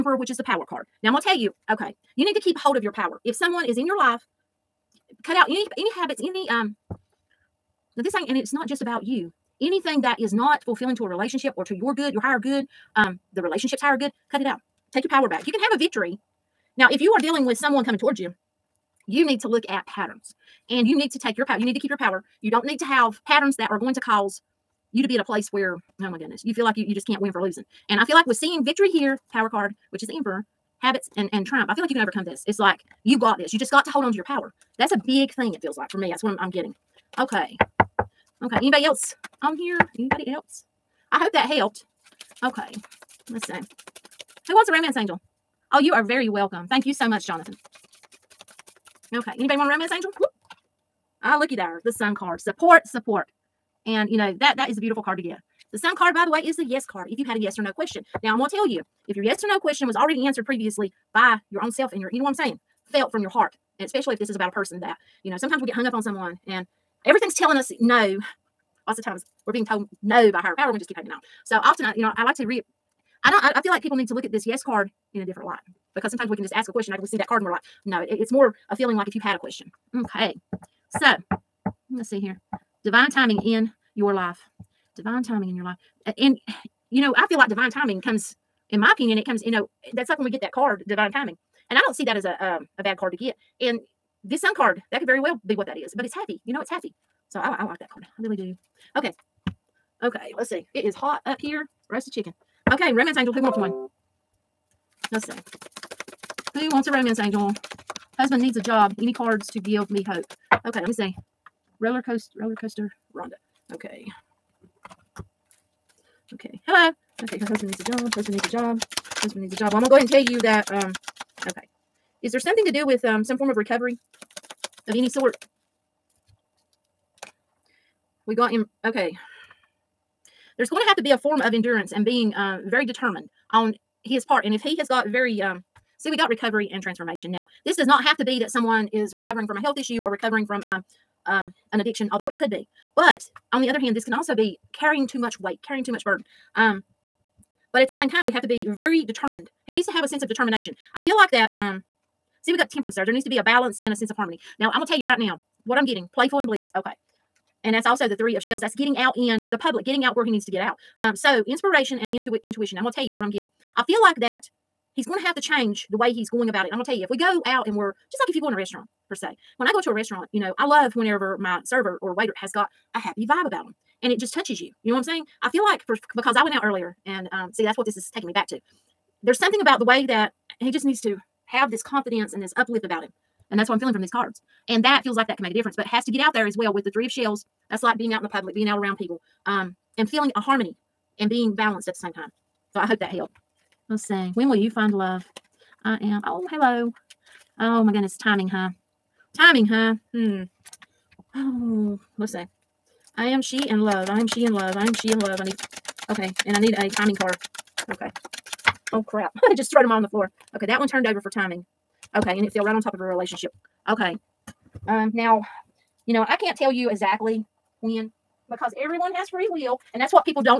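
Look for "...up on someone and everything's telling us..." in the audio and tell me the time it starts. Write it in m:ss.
1:05.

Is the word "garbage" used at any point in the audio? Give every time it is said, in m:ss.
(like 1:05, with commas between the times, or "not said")
not said.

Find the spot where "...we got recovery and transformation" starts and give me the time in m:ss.
2:16.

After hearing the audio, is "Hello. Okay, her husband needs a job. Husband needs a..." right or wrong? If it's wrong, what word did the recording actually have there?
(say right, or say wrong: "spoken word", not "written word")
right.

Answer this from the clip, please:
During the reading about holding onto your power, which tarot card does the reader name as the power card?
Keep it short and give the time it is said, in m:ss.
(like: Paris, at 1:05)
The Emperor, at 0:30.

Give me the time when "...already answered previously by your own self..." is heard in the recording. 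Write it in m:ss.
0:59.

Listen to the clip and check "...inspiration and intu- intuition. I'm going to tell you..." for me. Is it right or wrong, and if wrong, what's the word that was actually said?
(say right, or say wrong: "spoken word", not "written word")
right.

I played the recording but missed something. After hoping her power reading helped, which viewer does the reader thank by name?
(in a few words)
Jonathan.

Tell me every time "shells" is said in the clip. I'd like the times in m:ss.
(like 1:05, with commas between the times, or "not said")
2:38, 3:07.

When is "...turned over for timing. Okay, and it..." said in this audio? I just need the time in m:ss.
3:30.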